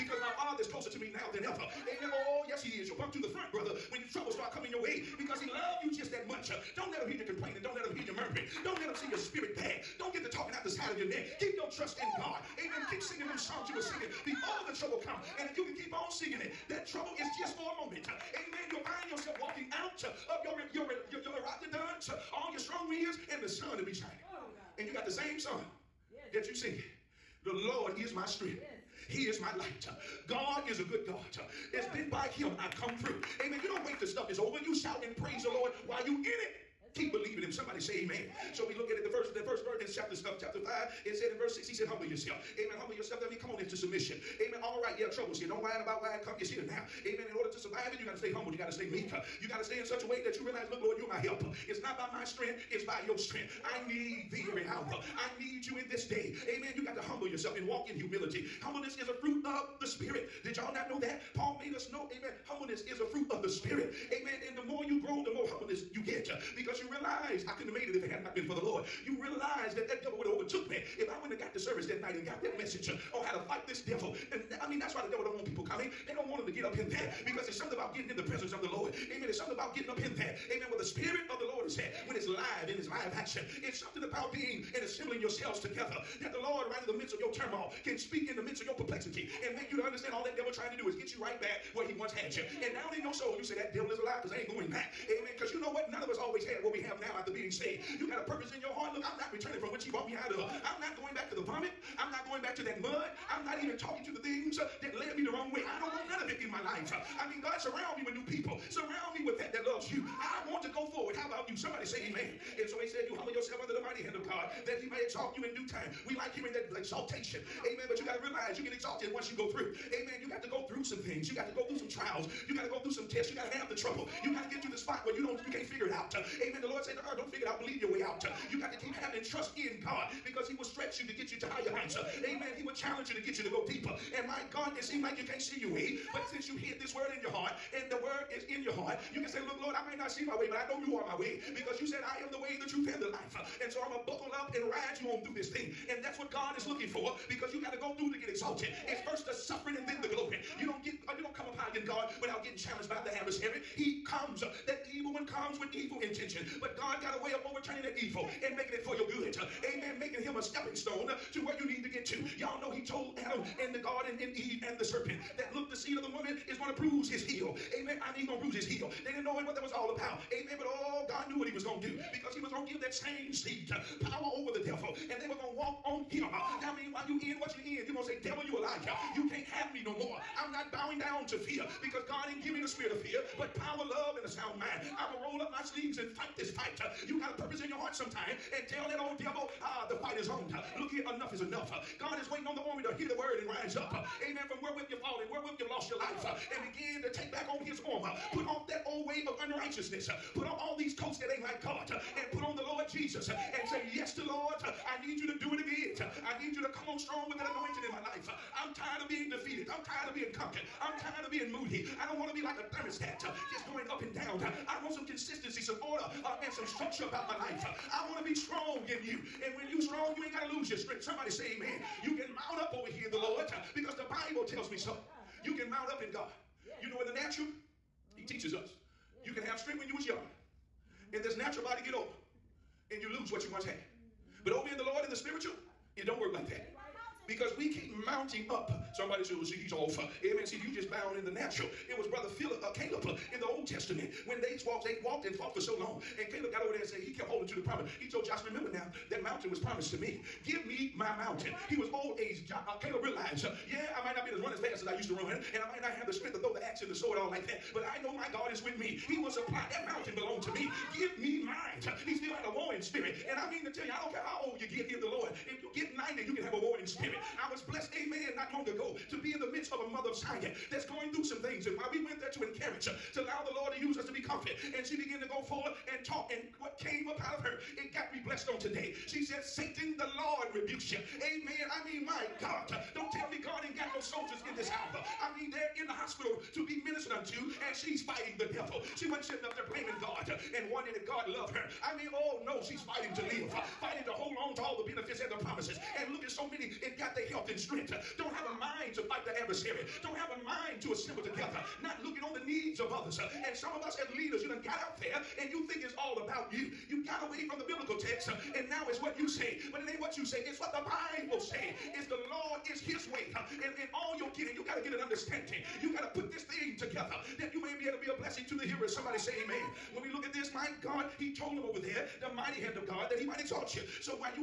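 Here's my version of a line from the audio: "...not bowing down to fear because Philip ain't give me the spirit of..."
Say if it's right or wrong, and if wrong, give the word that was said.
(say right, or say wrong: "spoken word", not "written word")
wrong: "God", not "Philip".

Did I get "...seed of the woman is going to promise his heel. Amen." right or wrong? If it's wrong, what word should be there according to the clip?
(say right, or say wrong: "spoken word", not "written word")
wrong: "bruise", not "promise".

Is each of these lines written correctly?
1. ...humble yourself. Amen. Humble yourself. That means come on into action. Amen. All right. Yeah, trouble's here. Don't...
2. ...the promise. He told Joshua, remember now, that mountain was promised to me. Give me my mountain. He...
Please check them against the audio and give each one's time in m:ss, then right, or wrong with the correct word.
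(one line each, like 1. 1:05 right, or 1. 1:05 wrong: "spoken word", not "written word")
1. 0:41 wrong: "submission", not "action"
2. 4:07 right.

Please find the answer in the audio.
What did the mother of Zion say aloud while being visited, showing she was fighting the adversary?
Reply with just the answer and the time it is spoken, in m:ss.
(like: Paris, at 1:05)
Satan, the Lord rebukes you, at 4:39.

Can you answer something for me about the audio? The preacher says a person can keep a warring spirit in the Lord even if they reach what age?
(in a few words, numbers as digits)
90.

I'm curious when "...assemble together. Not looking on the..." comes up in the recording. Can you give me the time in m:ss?
5:00.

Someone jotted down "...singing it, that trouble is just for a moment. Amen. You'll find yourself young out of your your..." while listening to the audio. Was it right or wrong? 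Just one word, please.
wrong.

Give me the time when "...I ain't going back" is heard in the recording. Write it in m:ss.
1:34.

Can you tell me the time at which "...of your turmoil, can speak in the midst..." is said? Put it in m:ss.
1:27.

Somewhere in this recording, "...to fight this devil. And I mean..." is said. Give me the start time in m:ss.
1:13.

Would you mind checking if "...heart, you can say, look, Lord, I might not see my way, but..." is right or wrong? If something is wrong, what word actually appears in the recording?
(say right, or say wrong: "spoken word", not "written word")
right.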